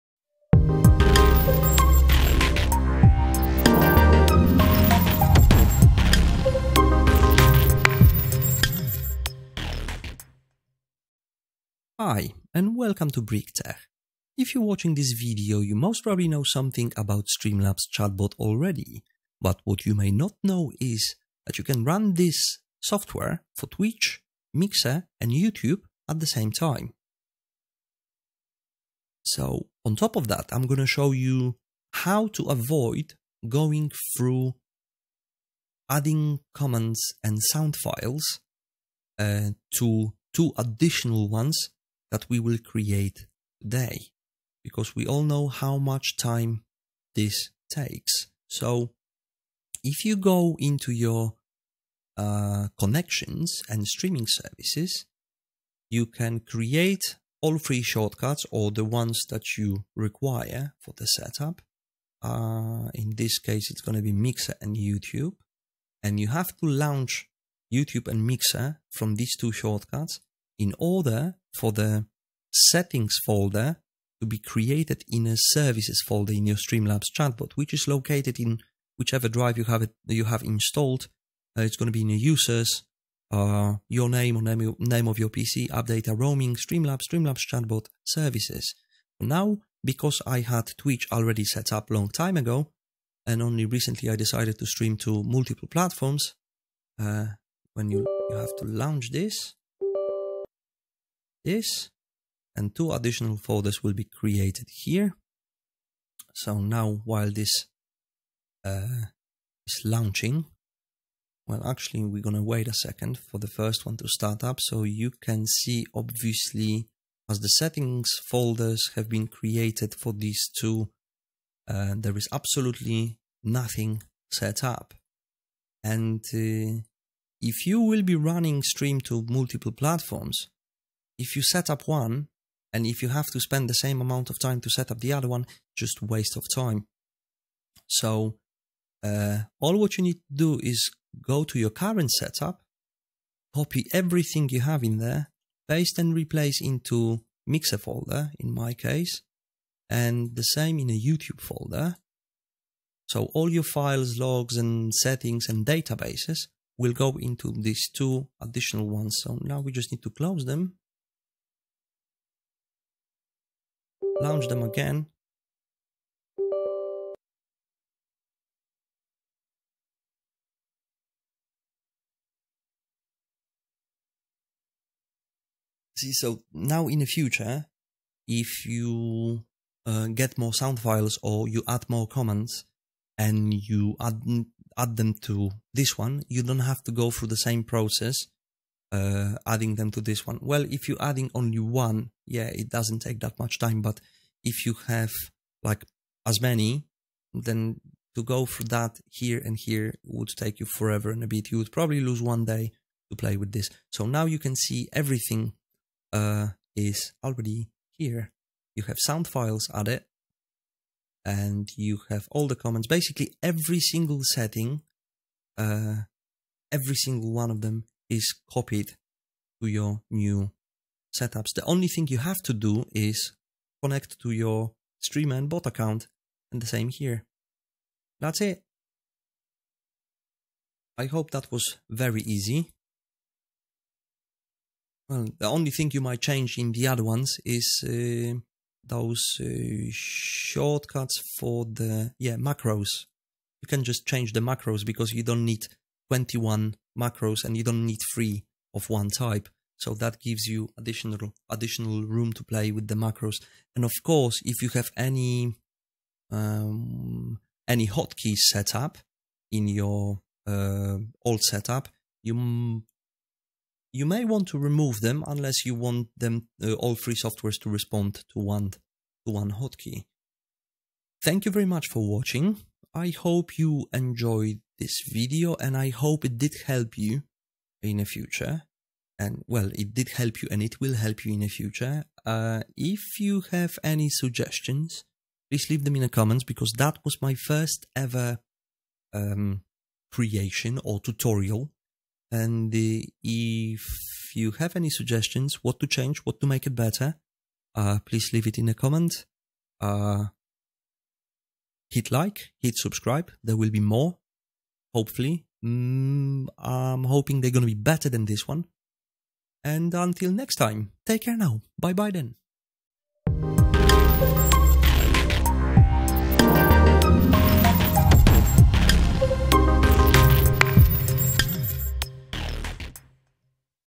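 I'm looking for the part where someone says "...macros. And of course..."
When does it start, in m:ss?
4:12.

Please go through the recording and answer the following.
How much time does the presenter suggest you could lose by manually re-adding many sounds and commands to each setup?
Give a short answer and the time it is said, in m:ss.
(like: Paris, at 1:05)
one day, at 3:22.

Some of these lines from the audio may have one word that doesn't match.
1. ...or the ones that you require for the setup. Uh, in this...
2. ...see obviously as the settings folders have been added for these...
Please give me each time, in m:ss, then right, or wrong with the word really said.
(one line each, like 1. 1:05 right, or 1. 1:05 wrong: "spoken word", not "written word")
1. 0:58 right
2. 1:55 wrong: "created", not "added".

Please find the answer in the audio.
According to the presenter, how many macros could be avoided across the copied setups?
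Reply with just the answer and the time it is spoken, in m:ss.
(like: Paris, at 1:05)
21, at 4:06.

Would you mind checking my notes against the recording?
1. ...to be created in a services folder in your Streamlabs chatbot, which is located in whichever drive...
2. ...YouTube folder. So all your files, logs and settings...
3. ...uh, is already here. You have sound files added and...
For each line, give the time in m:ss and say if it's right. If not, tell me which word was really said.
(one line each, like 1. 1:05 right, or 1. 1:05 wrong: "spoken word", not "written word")
1. 1:14 right
2. 2:31 right
3. 3:26 right.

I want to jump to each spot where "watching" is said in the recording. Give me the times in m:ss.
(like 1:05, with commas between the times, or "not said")
0:14, 4:32.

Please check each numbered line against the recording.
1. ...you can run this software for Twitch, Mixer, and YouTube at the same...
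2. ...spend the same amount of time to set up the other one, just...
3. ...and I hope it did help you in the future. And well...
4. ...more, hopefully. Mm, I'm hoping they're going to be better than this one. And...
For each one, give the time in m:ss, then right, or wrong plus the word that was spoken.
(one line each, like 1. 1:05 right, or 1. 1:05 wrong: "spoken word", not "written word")
1. 0:21 right
2. 2:13 right
3. 4:35 right
4. 5:03 right.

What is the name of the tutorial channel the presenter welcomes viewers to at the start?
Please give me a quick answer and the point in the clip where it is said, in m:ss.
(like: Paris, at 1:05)
BrickTech, at 0:13.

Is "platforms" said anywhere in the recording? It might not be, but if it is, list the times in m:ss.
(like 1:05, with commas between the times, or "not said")
1:35, 2:09.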